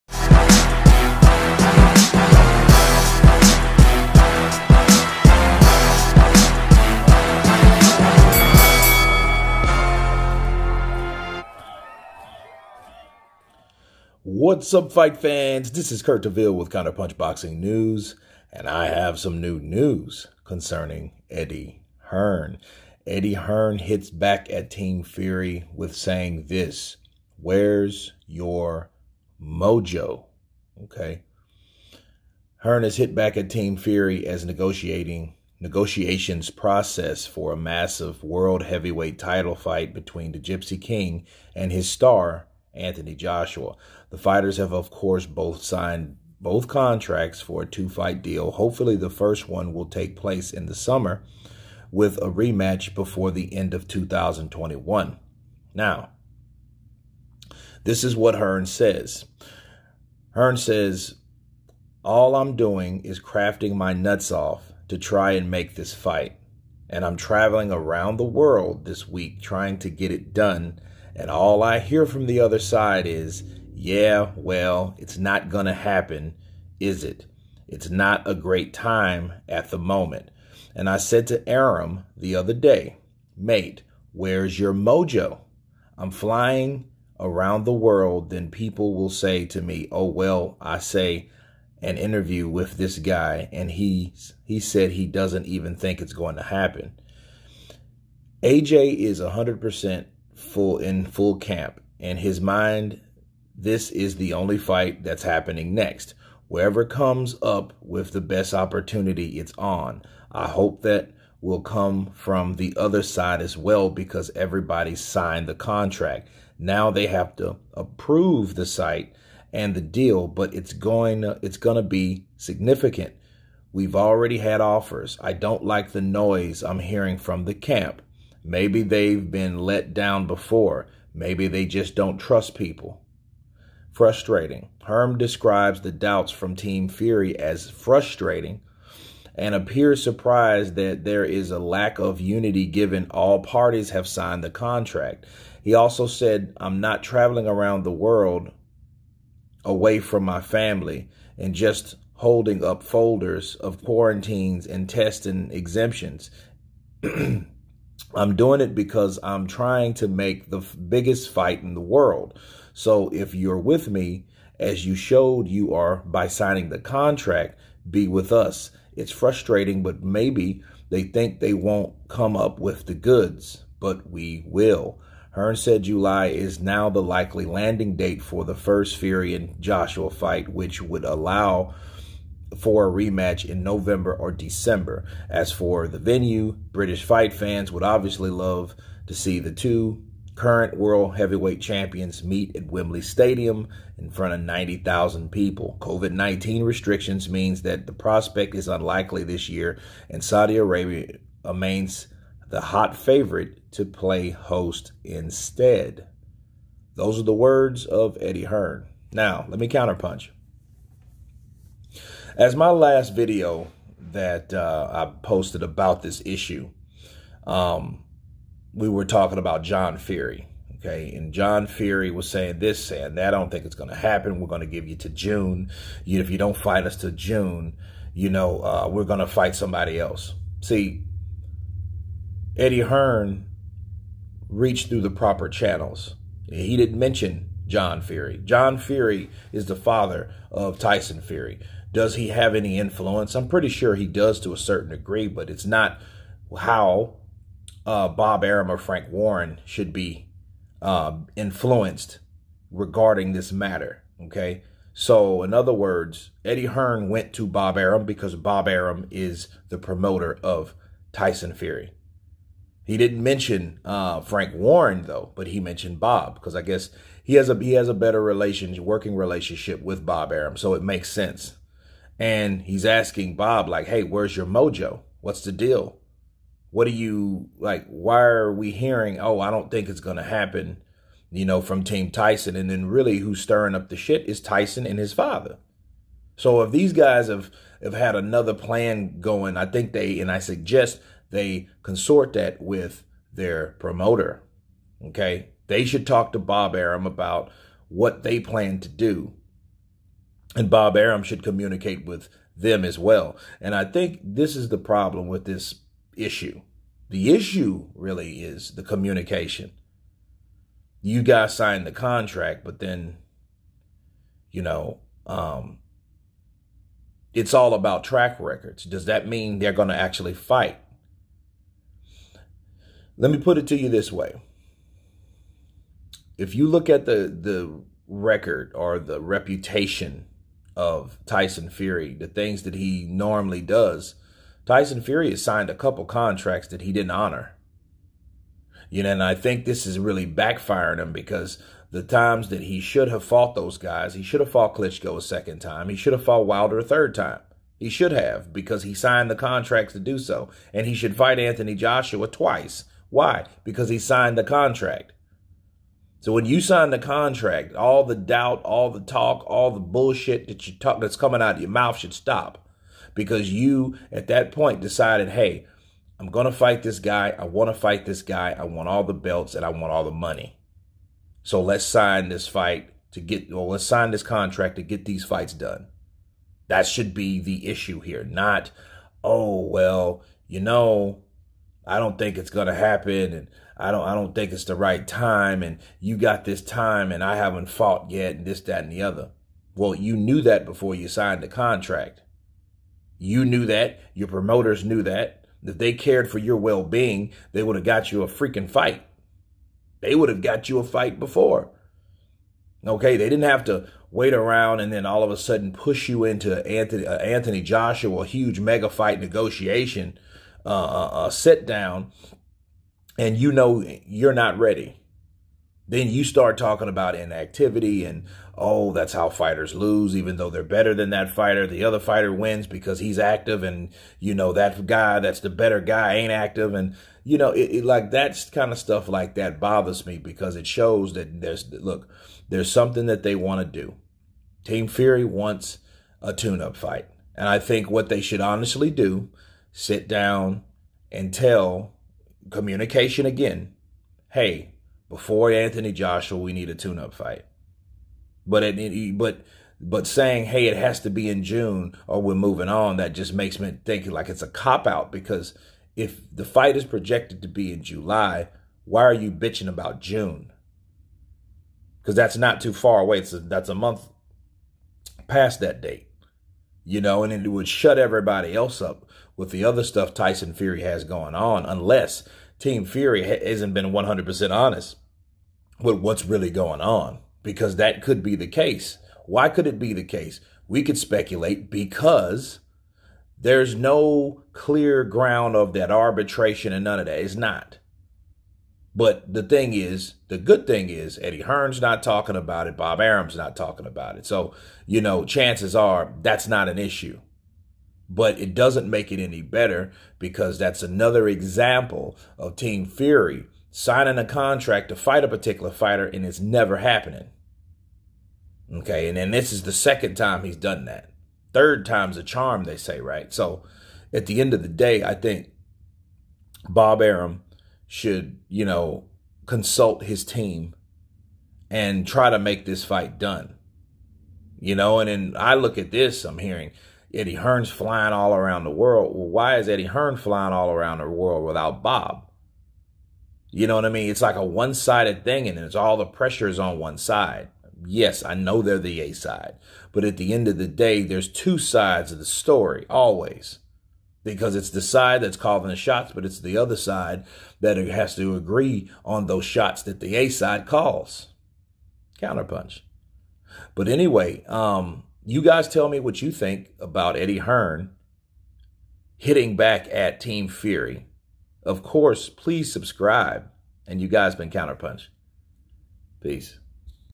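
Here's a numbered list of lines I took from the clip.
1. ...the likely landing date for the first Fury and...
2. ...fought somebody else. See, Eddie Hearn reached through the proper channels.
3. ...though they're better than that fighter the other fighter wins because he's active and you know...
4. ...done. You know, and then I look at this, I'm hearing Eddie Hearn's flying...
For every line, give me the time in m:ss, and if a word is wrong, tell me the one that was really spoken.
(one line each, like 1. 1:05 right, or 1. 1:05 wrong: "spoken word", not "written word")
1. 2:56 right
2. 3:49 wrong: "fight", not "fought"
3. 7:00 right
4. 8:43 right.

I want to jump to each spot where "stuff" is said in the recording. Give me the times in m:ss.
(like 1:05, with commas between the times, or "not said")
7:08, 7:49.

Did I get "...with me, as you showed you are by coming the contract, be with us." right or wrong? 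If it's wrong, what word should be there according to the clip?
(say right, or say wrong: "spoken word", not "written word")
wrong: "signing", not "coming".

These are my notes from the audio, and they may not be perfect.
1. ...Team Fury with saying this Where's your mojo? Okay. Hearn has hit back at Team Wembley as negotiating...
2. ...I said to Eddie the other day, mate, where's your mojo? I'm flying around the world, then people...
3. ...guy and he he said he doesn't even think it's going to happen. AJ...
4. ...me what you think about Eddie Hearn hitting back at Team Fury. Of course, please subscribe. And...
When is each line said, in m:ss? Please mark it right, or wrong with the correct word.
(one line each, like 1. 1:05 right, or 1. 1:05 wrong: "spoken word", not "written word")
1. 0:24 wrong: "Fury", not "Wembley"
2. 1:20 wrong: "Arum", not "Eddie"
3. 1:32 right
4. 9:15 right.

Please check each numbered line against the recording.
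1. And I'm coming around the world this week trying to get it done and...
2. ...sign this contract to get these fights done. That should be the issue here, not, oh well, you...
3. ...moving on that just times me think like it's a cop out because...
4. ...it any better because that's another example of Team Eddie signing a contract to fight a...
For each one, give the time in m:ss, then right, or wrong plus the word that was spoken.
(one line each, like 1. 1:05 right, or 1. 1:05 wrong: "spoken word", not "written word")
1. 1:06 wrong: "traveling", not "coming"
2. 6:13 right
3. 7:32 wrong: "makes", not "times"
4. 8:19 wrong: "Fury", not "Eddie".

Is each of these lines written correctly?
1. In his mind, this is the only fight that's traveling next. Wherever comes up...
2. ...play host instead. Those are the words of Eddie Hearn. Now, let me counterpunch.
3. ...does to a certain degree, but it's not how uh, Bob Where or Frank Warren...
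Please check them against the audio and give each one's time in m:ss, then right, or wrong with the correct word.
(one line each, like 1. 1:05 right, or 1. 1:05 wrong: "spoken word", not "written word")
1. 1:41 wrong: "happening", not "traveling"
2. 3:23 right
3. 4:04 wrong: "Arum", not "Where".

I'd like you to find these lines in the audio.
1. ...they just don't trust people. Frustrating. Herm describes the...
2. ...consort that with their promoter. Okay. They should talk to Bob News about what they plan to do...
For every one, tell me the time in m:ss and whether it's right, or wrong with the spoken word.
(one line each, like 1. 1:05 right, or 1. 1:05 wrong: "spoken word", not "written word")
1. 2:11 right
2. 4:51 wrong: "Arum", not "News".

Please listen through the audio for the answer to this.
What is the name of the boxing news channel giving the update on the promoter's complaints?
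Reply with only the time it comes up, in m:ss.
0:16.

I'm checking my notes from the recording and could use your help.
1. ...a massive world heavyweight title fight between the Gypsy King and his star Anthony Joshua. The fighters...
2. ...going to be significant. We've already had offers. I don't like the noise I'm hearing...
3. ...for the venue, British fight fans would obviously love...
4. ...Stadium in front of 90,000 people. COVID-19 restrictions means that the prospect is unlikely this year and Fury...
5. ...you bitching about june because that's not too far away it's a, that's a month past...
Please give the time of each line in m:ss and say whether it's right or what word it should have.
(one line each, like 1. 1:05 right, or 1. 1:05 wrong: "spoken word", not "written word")
1. 0:37 right
2. 2:01 right
3. 3:05 right
4. 3:13 wrong: "Saudi", not "Fury"
5. 7:39 right.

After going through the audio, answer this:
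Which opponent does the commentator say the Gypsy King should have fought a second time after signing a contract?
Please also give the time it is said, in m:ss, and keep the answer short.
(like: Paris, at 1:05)
Klitschko, at 5:44.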